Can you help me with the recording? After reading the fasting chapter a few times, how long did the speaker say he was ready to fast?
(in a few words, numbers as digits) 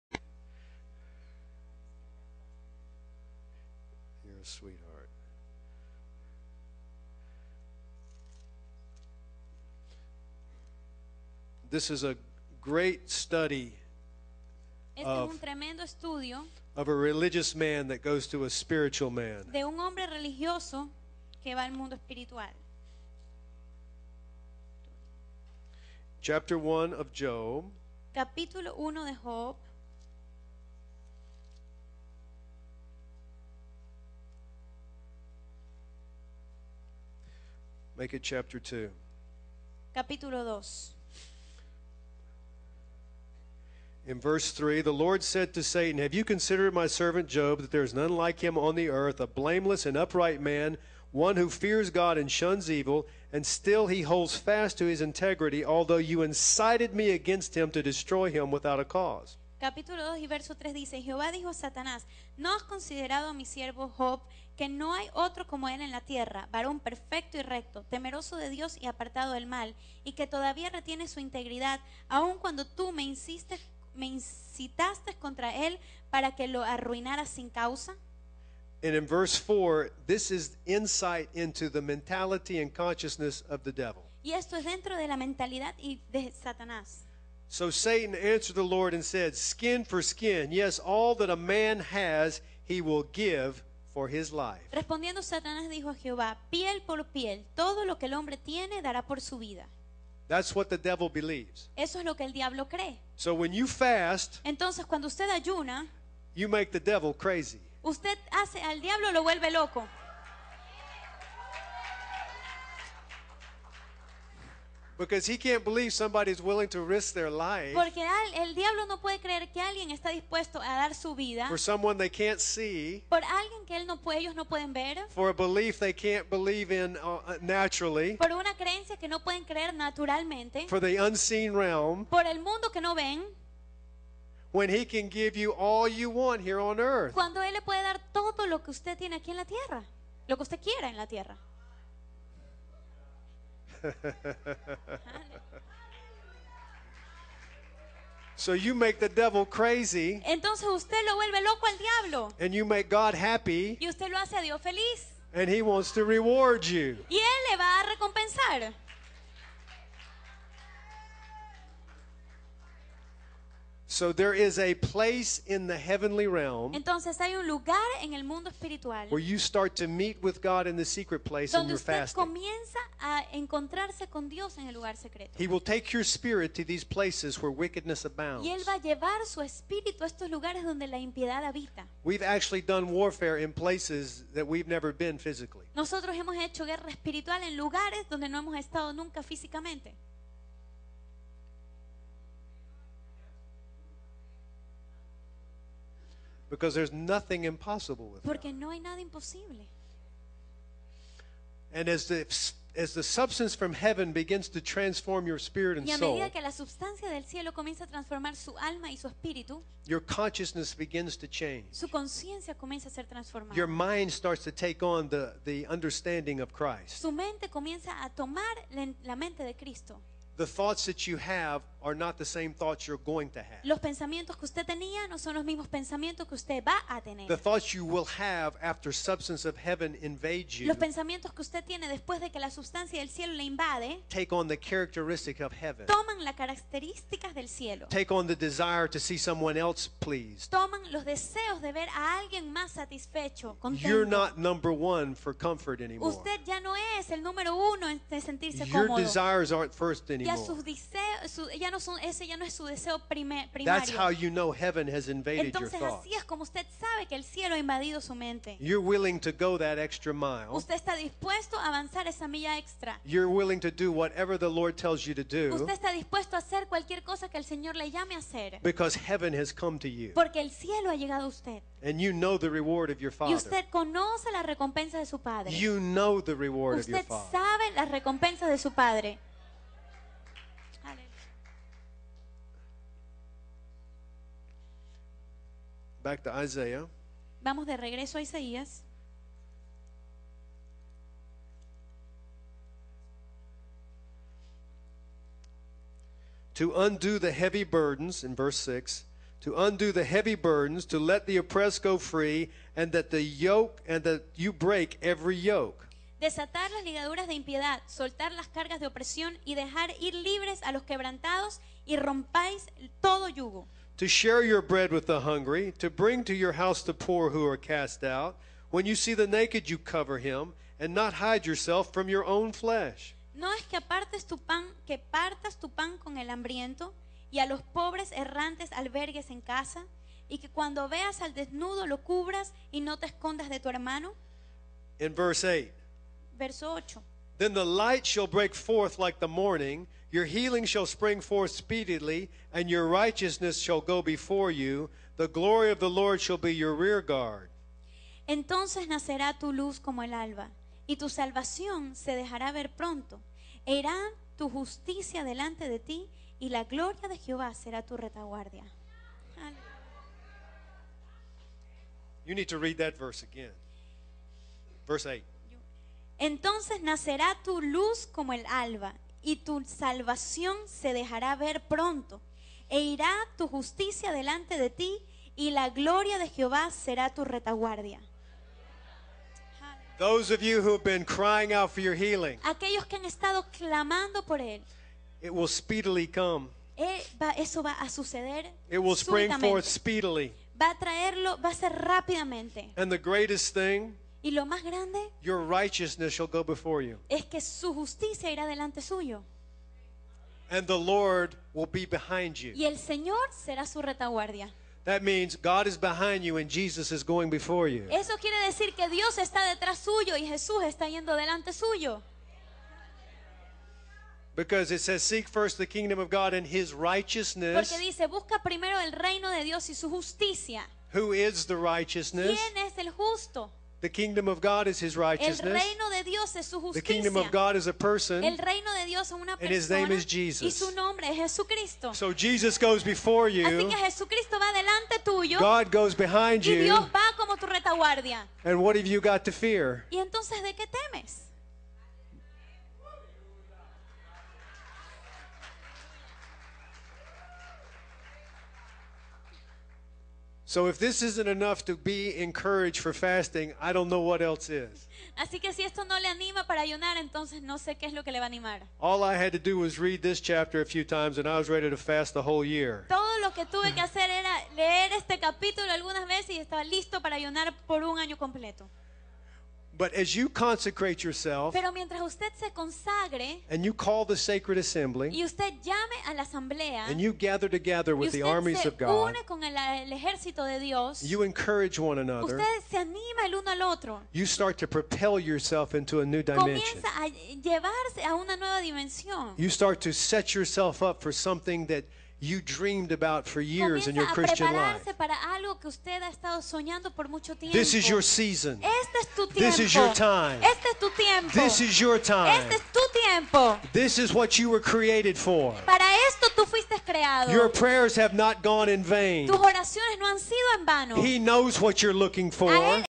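The whole year.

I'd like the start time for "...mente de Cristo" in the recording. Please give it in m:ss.
3:39.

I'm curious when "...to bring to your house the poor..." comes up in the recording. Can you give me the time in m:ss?
5:15.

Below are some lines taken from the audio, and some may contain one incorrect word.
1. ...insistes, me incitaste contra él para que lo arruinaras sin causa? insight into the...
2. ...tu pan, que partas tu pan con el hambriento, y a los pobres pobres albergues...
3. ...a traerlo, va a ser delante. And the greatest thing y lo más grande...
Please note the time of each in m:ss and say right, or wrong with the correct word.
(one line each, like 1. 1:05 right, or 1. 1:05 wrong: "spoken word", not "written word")
1. 1:13 right
2. 5:24 wrong: "errantes", not "pobres"
3. 6:30 wrong: "rápidamente", not "delante".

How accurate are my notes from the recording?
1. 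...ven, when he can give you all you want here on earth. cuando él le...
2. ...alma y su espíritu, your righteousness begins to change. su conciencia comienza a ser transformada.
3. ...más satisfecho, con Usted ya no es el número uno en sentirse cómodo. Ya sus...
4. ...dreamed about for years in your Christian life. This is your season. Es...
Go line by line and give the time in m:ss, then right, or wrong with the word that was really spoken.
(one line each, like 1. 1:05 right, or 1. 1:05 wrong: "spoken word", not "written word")
1. 2:12 right
2. 3:28 wrong: "consciousness", not "righteousness"
3. 4:02 right
4. 8:12 right.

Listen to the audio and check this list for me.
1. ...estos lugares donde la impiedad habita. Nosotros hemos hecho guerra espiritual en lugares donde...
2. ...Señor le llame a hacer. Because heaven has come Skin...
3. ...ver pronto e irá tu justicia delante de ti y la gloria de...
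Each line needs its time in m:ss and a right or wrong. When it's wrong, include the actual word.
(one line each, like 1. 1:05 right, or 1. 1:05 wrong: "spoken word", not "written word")
1. 3:00 right
2. 4:27 wrong: "Porque", not "Skin"
3. 6:11 right.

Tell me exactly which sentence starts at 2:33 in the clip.
Y usted lo hace a Dios feliz.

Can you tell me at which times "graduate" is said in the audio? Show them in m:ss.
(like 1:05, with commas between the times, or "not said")
not said.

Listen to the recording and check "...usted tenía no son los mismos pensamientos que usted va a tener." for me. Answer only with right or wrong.
right.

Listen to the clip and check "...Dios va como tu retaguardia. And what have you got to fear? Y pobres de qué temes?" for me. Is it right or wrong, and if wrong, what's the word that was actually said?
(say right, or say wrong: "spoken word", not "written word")
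wrong: "entonces", not "pobres".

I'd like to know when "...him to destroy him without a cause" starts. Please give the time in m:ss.
0:57.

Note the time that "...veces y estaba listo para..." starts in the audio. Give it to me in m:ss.
7:46.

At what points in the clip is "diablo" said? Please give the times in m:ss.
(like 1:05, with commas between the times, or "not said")
1:42, 1:48, 1:58, 2:31.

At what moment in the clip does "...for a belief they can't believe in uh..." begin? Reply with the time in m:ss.
2:05.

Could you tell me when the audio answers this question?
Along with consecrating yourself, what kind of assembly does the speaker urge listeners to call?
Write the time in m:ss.
7:54.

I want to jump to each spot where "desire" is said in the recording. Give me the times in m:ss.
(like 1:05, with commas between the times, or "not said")
3:58.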